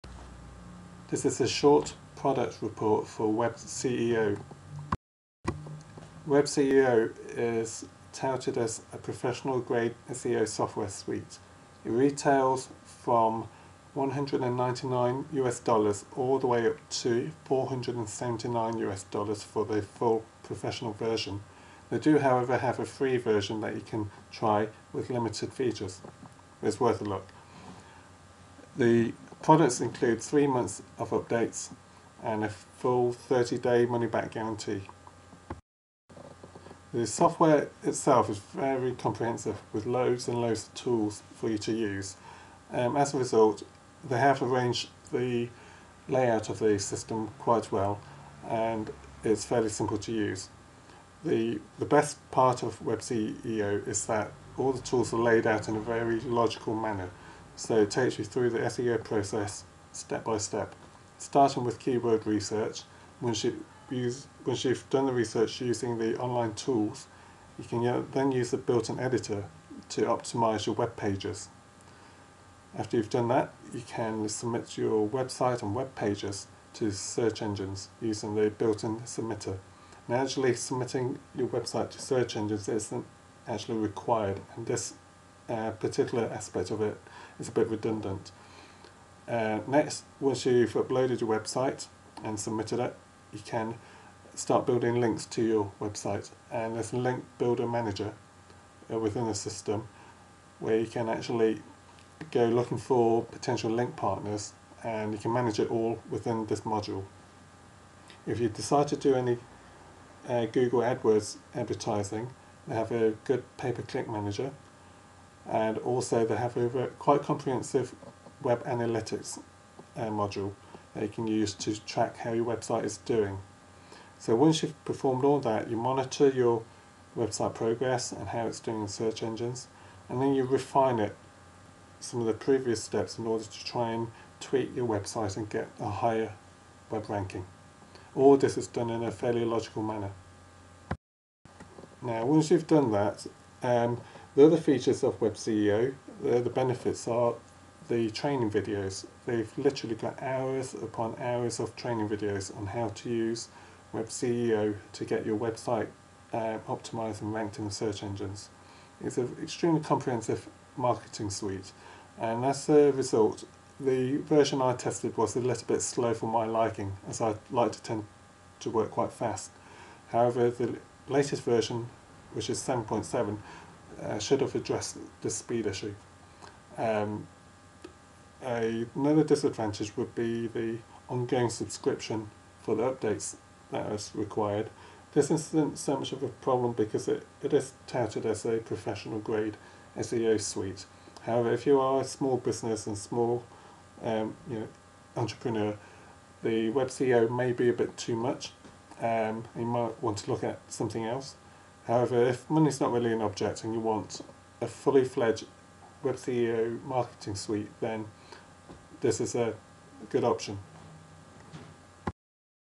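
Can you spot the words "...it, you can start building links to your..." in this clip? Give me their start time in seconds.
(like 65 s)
92 s.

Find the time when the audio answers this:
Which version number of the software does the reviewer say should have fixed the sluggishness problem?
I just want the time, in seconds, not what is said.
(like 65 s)
172 s.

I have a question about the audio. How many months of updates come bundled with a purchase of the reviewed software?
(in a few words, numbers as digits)
3.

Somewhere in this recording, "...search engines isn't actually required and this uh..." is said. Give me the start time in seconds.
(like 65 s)
82 s.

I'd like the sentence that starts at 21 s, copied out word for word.
They do however have a free version that you can try with limited features.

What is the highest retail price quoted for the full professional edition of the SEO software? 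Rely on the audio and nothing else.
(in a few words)
$479.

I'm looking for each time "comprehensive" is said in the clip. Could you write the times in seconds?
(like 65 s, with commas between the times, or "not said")
38 s, 117 s, 159 s.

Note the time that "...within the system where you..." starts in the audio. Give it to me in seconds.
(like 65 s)
98 s.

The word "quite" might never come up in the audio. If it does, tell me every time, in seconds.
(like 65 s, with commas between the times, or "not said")
47 s, 116 s, 168 s.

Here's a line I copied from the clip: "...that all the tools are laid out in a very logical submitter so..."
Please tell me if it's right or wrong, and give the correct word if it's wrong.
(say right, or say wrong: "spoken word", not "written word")
wrong: "manner", not "submitter".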